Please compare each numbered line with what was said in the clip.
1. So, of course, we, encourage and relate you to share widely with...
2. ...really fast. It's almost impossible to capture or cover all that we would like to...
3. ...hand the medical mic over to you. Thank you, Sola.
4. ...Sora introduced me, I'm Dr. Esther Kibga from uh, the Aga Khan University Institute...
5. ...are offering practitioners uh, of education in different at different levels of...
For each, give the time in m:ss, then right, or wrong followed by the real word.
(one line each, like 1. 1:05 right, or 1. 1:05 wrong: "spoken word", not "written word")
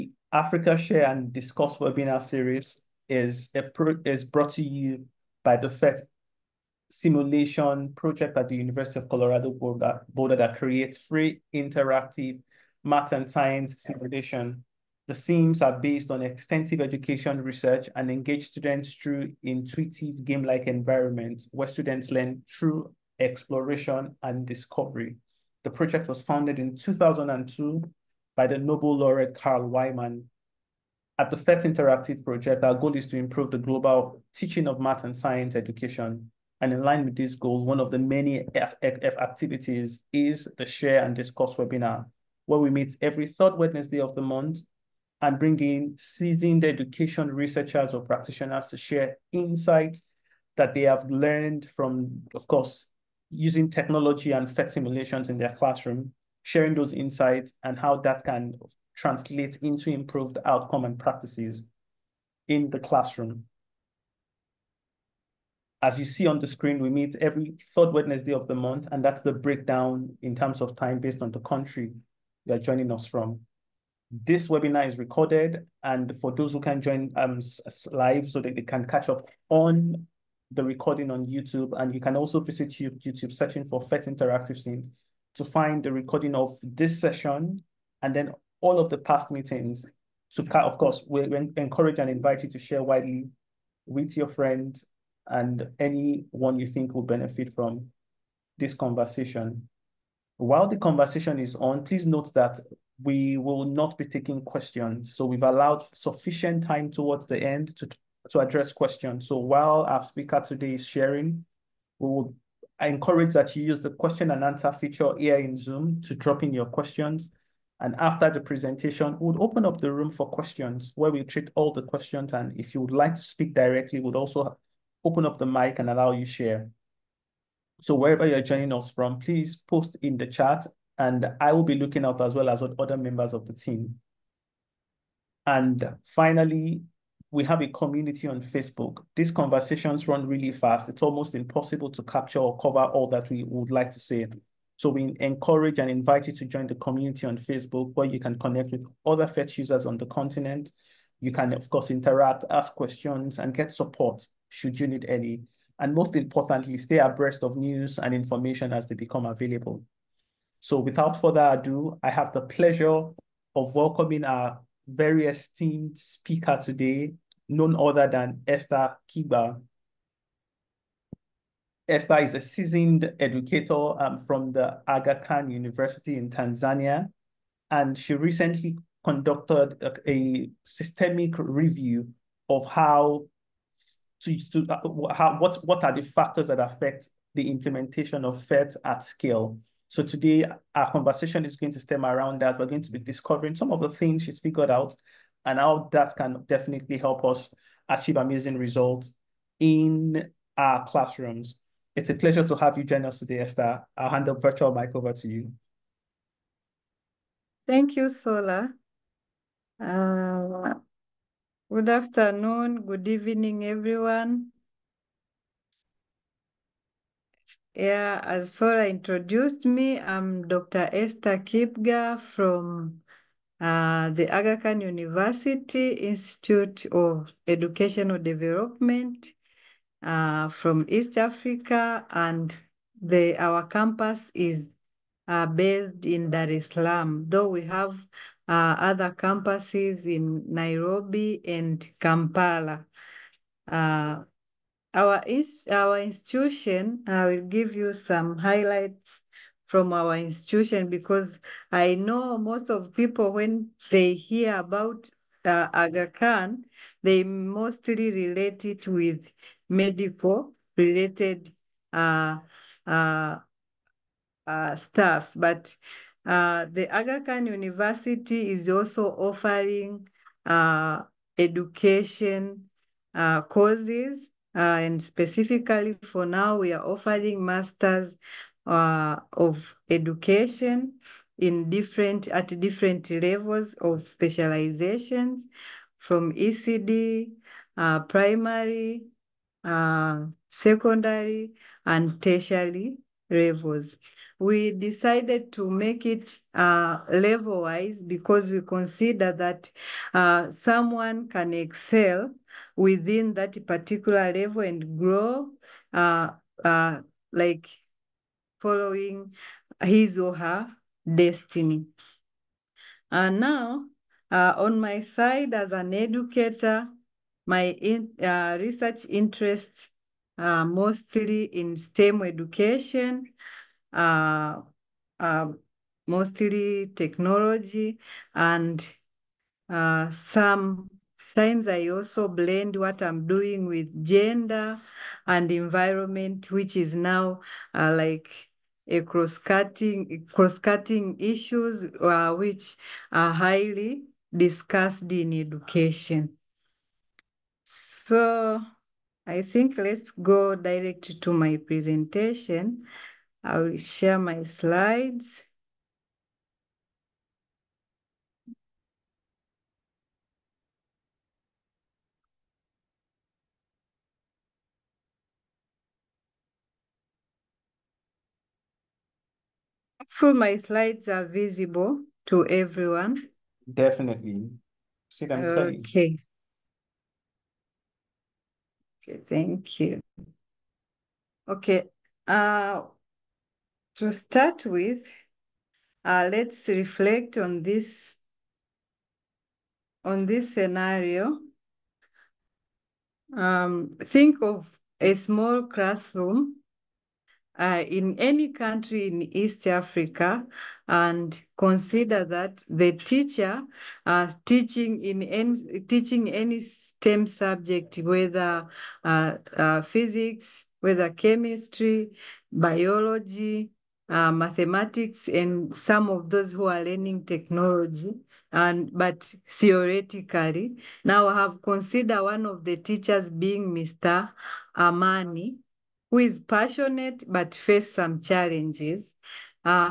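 1. 1:30 wrong: "invite", not "relate"
2. 2:20 right
3. 3:24 wrong: "virtual", not "medical"
4. 3:38 right
5. 4:36 wrong: "masters", not "practitioners".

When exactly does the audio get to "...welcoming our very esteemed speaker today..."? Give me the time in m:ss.
2:43.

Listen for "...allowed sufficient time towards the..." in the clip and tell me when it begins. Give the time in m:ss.
1:45.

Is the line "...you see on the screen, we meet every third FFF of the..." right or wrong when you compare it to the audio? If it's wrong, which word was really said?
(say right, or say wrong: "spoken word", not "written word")
wrong: "Wednesday", not "FFF".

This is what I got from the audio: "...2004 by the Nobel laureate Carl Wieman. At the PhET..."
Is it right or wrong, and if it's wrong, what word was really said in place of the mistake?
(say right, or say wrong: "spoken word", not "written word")
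wrong: "2002", not "2004".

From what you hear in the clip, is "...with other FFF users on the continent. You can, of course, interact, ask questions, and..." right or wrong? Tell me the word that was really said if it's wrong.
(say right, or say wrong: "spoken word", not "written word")
wrong: "PhET", not "FFF".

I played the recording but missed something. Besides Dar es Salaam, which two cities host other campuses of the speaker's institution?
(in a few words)
Nairobi and Kampala.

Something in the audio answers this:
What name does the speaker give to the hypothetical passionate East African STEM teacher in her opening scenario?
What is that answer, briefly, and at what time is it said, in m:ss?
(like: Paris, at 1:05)
Mr. Amani, at 7:03.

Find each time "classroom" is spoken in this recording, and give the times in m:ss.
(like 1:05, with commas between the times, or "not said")
0:55, 1:02, 3:20, 6:35.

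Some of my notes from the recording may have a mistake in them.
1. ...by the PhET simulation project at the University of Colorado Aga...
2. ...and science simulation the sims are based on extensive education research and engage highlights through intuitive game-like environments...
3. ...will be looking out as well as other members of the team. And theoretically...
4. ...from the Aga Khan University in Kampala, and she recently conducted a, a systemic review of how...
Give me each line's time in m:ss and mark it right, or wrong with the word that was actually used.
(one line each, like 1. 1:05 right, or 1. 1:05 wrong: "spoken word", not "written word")
1. 0:05 wrong: "Boulder", not "Aga"
2. 0:13 wrong: "students", not "highlights"
3. 2:11 wrong: "finally", not "theoretically"
4. 2:54 wrong: "Tanzania", not "Kampala".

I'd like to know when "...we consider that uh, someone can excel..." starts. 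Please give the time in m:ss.
4:58.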